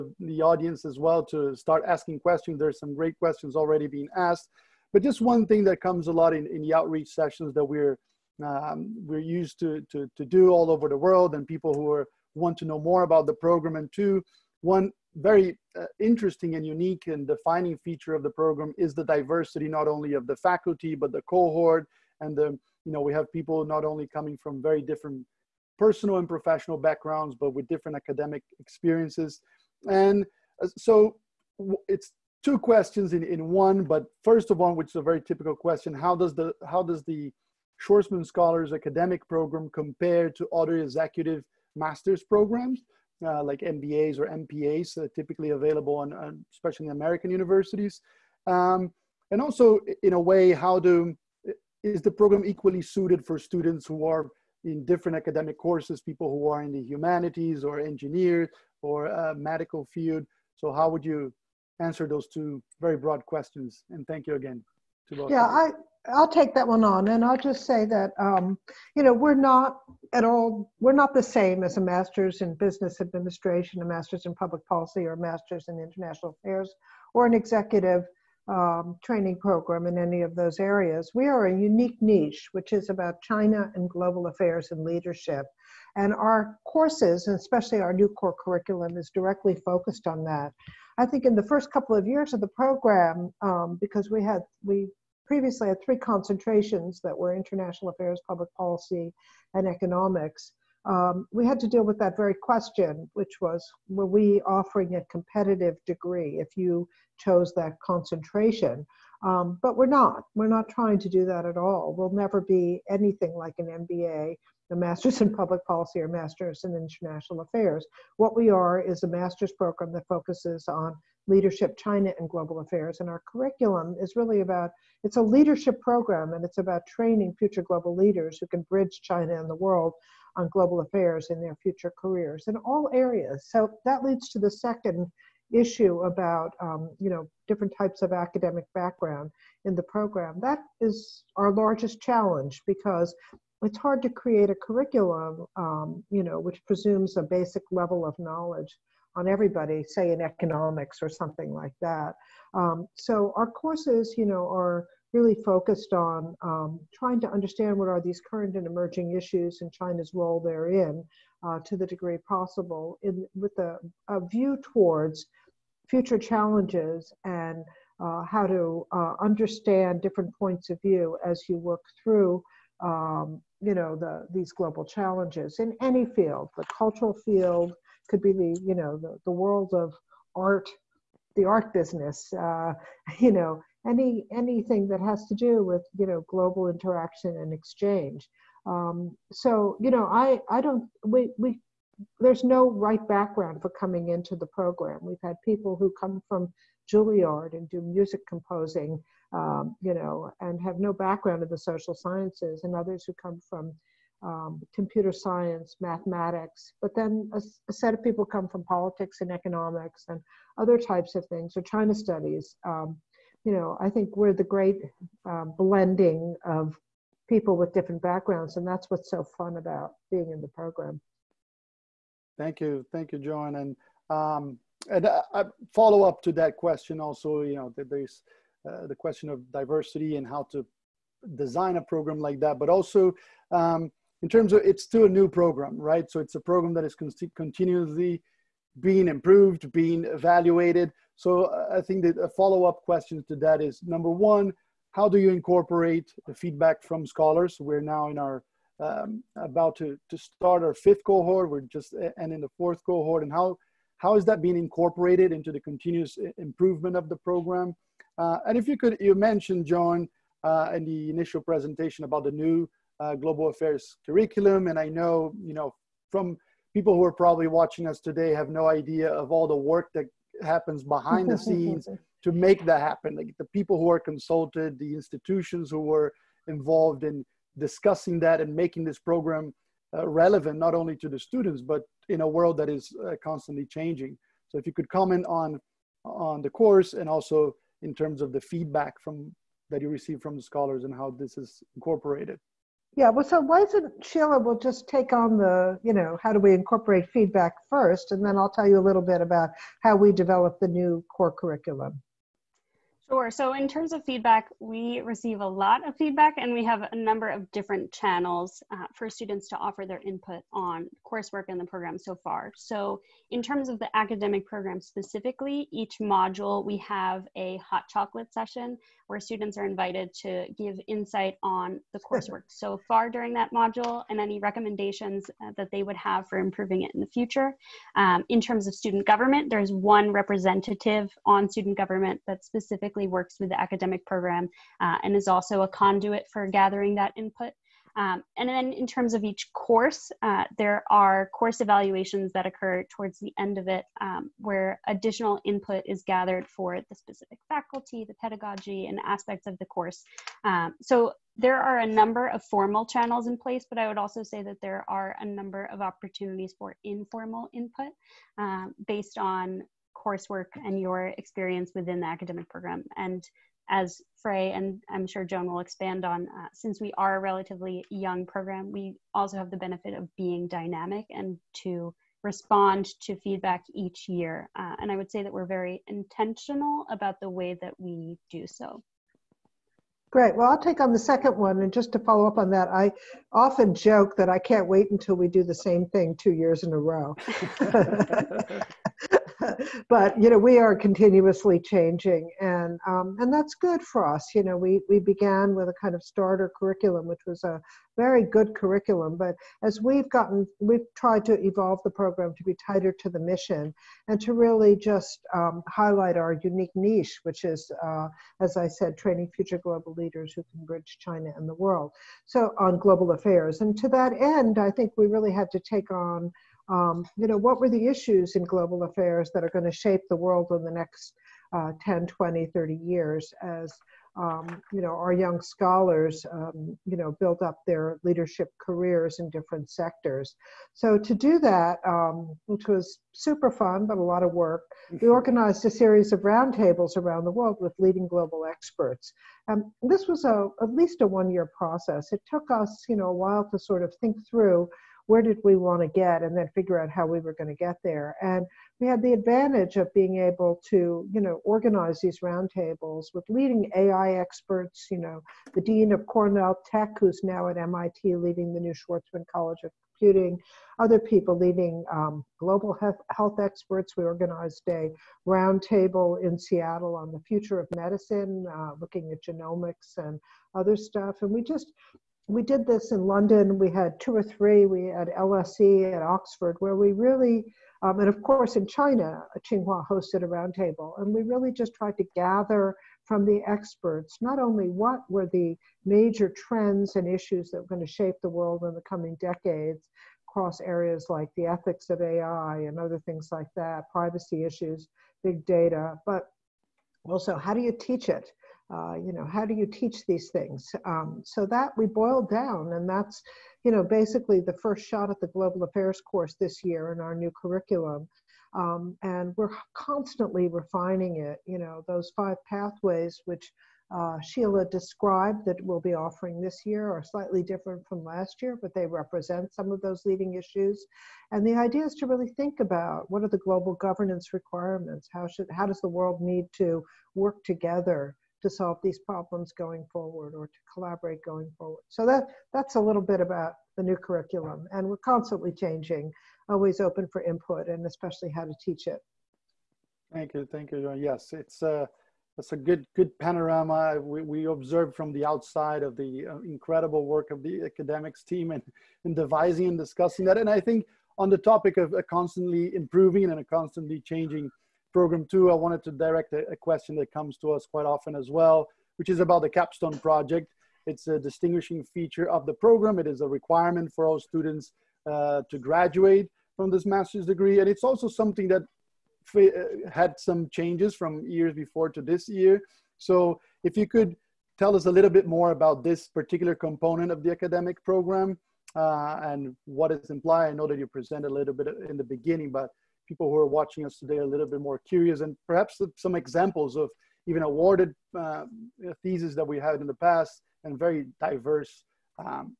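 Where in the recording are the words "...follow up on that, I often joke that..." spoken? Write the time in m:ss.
6:21.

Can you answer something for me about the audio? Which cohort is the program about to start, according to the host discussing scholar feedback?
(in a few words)
fifth.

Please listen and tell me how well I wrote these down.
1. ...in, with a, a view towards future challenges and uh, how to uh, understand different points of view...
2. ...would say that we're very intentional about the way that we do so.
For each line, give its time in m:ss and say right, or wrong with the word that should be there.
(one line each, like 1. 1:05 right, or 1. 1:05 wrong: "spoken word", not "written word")
1. 2:43 right
2. 6:14 right.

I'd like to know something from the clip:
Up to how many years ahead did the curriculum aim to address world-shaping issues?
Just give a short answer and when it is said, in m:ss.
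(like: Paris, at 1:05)
30, at 7:02.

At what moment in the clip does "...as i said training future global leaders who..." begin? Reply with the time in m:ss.
6:48.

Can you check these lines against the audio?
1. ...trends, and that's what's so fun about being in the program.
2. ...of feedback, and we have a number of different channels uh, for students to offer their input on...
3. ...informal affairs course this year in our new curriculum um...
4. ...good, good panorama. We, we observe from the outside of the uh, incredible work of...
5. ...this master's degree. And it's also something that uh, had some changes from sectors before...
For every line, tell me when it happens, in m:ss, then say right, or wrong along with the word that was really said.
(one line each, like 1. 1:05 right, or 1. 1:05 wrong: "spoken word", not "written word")
1. 3:38 wrong: "backgrounds", not "trends"
2. 5:05 right
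3. 8:25 wrong: "global", not "informal"
4. 9:02 right
5. 9:26 wrong: "years", not "sectors".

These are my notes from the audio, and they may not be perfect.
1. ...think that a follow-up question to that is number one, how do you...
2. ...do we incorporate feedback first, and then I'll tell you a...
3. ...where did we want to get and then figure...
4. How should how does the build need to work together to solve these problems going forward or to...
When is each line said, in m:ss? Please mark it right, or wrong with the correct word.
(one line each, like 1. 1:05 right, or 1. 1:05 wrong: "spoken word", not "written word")
1. 4:01 right
2. 4:56 right
3. 7:25 right
4. 8:45 wrong: "world", not "build".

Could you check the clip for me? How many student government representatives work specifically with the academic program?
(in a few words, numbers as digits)
1.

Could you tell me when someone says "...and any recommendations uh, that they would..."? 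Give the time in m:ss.
5:24.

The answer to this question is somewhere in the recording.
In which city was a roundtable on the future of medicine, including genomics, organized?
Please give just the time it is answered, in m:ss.
7:46.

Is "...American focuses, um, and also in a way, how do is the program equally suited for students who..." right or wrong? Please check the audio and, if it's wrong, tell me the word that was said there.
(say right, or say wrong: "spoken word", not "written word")
wrong: "universities", not "focuses".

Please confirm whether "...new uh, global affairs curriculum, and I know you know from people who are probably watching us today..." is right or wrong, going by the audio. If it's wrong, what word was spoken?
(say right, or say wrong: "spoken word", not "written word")
right.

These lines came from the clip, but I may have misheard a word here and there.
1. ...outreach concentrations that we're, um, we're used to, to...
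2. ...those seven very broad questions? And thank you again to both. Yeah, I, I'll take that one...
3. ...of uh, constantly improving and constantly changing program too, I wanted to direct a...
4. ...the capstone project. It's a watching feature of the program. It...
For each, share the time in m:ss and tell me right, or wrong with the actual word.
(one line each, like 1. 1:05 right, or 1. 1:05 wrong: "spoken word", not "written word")
1. 0:06 wrong: "sessions", not "concentrations"
2. 1:02 wrong: "two", not "seven"
3. 9:11 right
4. 9:19 wrong: "distinguishing", not "watching".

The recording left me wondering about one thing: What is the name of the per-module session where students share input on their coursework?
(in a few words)
hot chocolate session.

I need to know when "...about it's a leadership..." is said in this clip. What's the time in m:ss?
2:04.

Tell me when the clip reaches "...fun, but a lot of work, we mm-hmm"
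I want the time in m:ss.
7:13.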